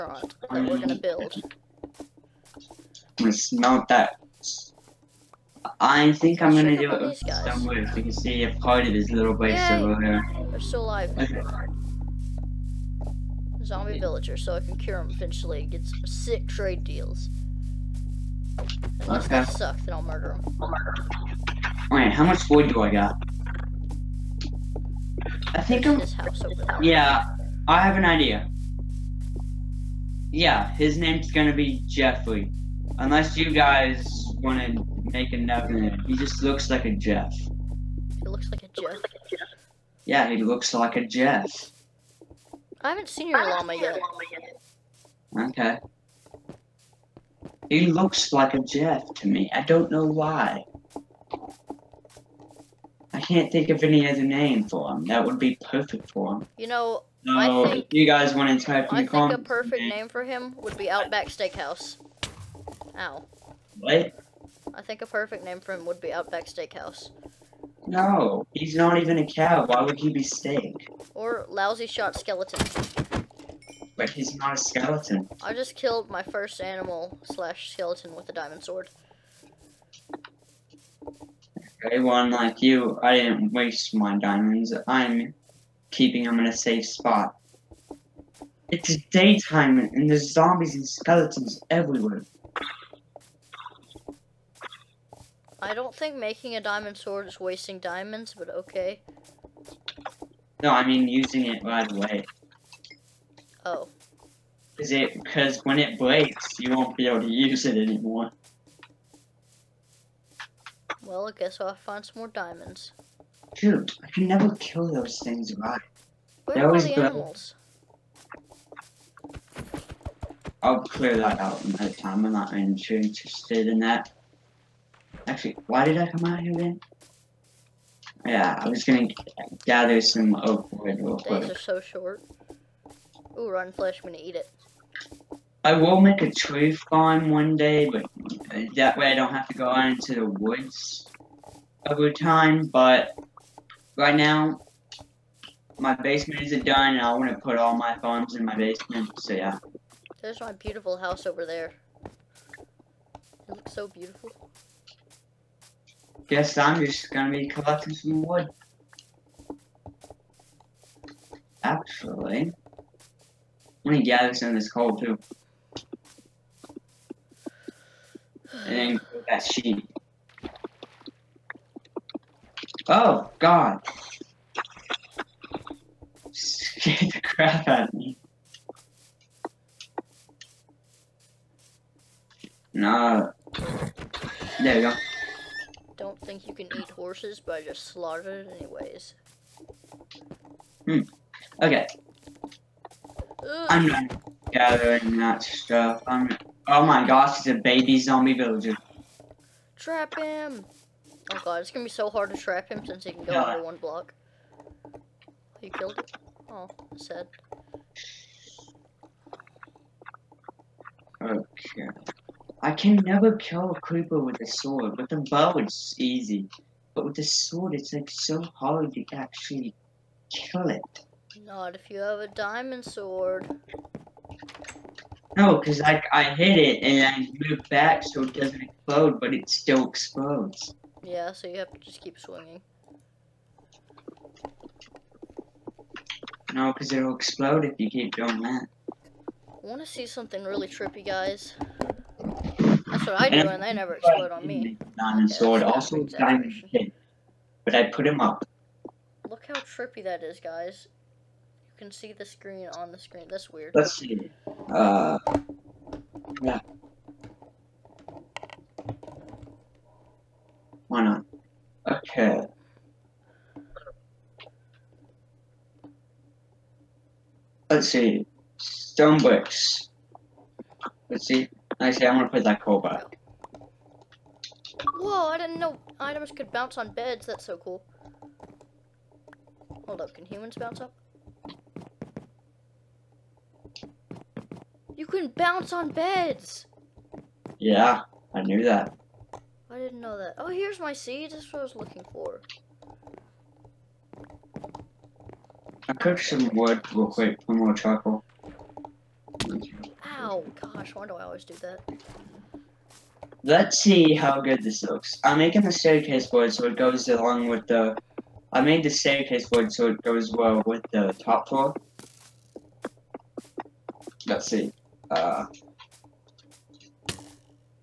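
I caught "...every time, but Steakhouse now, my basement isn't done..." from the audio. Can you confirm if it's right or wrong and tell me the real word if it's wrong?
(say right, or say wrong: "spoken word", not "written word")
wrong: "Right", not "Steakhouse".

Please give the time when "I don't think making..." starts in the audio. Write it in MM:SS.
01:35.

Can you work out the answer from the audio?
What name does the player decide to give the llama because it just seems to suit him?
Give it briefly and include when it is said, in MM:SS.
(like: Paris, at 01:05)
Jeffrey, at 00:31.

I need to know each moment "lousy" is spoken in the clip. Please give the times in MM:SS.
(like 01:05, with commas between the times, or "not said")
01:11.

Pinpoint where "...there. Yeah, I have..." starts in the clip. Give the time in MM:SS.
00:26.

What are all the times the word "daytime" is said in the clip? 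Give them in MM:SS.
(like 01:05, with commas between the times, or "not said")
01:29.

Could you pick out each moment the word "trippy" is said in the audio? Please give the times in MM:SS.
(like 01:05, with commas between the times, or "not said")
04:00, 04:09.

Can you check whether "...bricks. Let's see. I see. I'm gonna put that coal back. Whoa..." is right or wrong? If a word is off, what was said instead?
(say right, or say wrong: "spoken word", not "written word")
right.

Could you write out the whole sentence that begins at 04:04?
Diamond okay, sword, also diamond hit, but I put him up.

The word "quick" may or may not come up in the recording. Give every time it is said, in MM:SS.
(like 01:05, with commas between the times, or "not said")
02:11, 04:57.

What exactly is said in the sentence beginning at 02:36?
Guess I'm just gonna be collecting some wood.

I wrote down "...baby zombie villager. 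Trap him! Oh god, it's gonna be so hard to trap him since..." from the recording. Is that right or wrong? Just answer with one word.
right.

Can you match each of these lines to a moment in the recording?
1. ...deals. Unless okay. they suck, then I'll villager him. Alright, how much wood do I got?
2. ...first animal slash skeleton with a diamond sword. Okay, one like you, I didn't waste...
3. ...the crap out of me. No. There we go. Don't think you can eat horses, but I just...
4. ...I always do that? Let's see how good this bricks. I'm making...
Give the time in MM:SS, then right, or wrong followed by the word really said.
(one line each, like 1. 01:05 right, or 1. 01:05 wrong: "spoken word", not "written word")
1. 00:16 wrong: "murder", not "villager"
2. 01:16 right
3. 02:57 right
4. 05:01 wrong: "looks", not "bricks".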